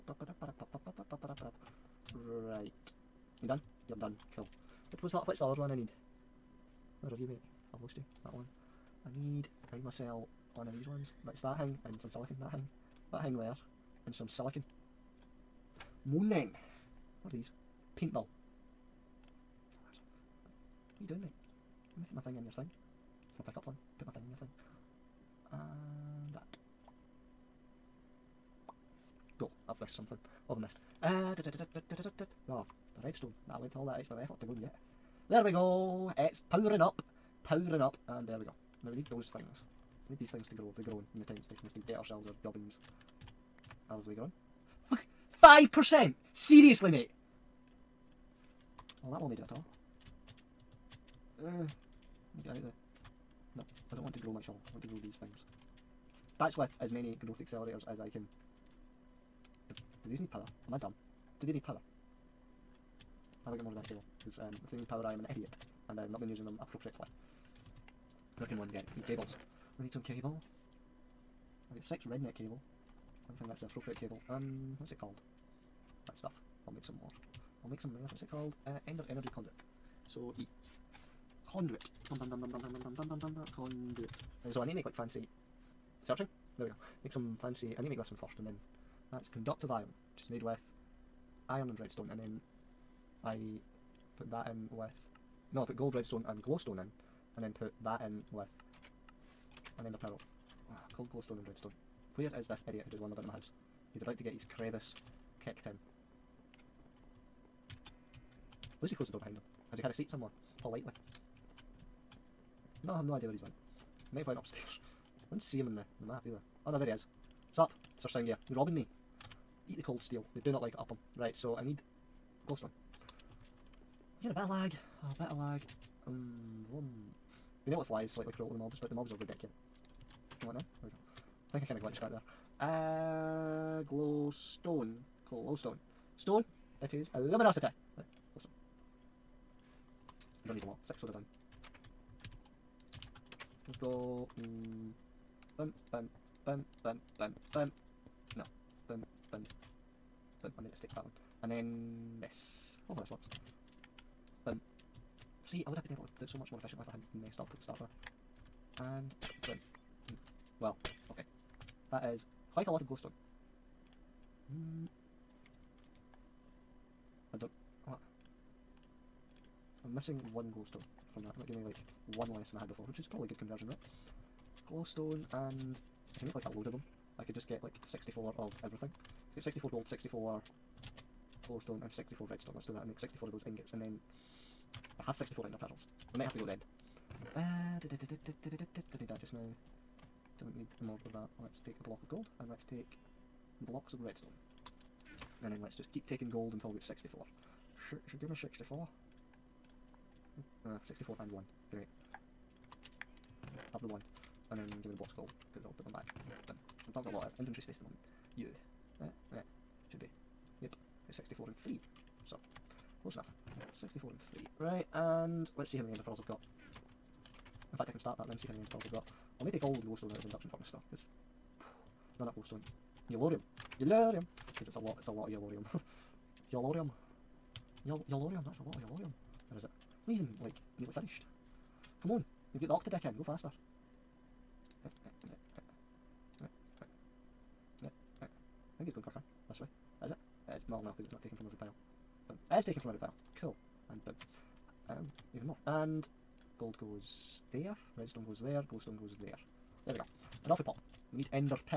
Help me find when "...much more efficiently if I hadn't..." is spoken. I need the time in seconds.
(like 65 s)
156 s.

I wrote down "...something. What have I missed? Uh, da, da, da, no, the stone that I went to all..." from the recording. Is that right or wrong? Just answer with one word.
wrong.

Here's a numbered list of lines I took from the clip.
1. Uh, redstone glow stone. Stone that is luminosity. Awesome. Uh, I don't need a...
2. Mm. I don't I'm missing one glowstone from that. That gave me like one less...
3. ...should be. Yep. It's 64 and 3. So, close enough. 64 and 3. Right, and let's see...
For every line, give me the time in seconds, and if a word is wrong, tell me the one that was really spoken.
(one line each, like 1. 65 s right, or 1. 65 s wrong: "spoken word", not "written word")
1. 133 s wrong: "glowstone", not "redstone"
2. 164 s right
3. 209 s right.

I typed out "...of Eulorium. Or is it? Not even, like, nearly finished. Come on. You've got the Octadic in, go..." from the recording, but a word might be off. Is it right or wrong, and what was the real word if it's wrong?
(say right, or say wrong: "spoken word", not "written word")
right.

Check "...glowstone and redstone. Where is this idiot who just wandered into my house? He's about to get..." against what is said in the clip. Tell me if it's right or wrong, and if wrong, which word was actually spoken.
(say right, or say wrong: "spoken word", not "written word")
right.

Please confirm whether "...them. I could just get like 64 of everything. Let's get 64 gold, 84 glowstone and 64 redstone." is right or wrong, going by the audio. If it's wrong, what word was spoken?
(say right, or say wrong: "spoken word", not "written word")
wrong: "64", not "84".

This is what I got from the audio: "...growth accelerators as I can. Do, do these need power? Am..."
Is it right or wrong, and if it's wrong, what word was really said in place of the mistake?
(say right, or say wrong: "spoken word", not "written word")
right.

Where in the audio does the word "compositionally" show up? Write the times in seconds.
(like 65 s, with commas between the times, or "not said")
not said.